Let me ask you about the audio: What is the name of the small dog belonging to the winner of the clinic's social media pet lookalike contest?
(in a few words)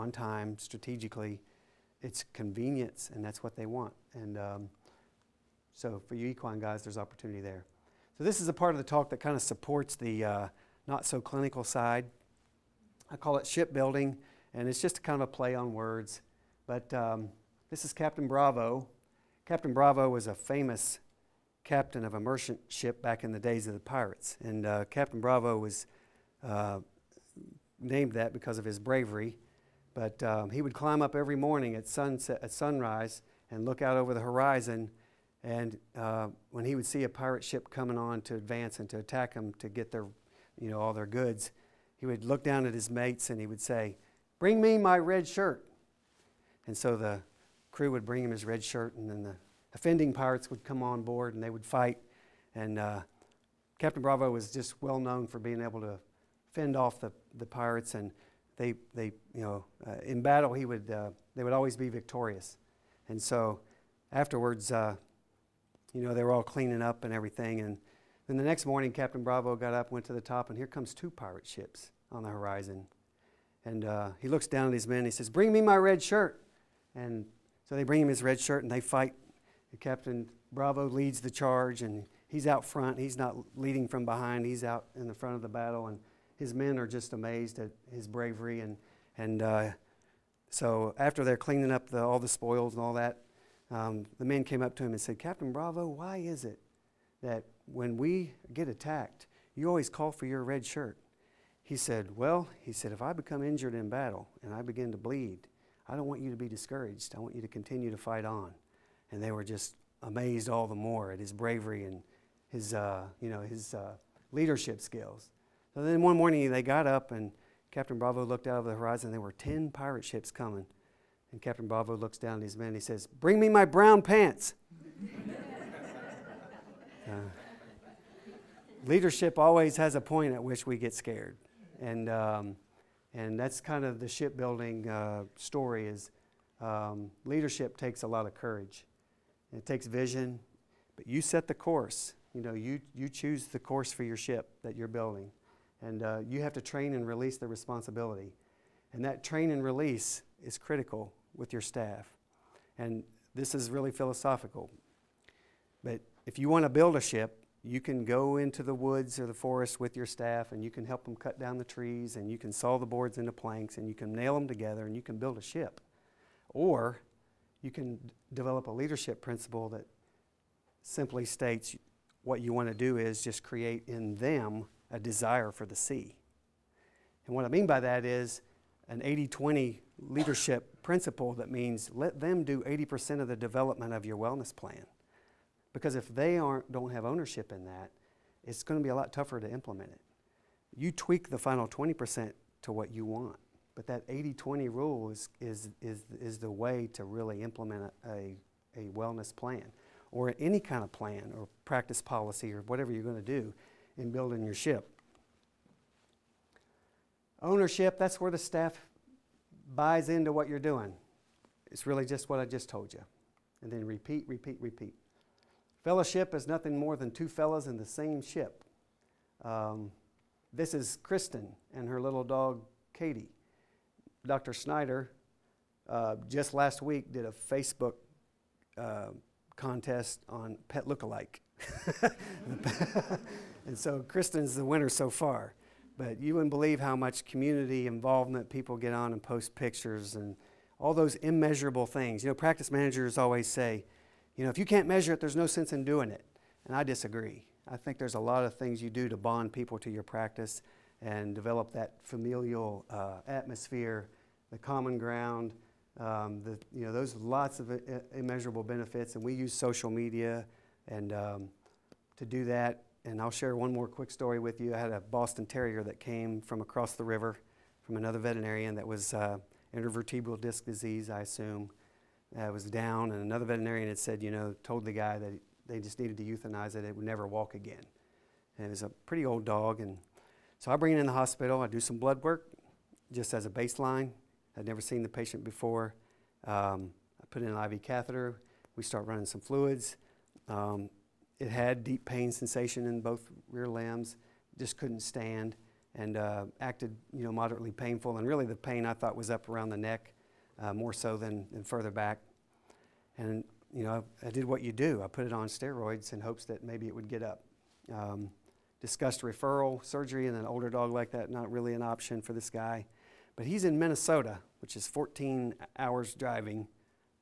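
Katie.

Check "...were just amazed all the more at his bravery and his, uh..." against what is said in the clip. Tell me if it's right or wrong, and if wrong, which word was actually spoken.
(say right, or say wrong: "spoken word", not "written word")
right.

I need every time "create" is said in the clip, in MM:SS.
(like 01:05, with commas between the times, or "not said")
02:53.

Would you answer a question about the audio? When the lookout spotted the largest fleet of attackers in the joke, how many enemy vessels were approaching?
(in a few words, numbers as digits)
10.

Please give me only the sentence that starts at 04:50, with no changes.
Um, it had deep pain sensation in both rear limbs, just couldn't stand, and uh, acted you know moderately painful.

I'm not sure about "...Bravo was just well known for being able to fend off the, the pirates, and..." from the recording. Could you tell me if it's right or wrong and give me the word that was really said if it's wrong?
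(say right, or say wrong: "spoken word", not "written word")
right.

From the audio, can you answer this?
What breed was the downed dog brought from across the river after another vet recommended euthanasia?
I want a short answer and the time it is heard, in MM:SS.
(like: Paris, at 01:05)
Boston Terrier, at 04:24.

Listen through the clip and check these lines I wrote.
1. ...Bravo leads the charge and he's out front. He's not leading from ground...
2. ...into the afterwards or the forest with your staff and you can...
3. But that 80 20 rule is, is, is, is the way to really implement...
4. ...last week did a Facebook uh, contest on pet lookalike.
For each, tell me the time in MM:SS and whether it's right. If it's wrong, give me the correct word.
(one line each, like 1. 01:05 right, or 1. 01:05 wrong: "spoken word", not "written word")
1. 01:20 wrong: "behind", not "ground"
2. 02:38 wrong: "woods", not "afterwards"
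3. 03:13 right
4. 03:46 right.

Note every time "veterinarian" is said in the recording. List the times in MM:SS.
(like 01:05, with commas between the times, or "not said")
04:28, 04:33.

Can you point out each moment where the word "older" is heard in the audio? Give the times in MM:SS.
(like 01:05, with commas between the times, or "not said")
05:10.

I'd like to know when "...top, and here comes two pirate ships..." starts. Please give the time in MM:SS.
01:10.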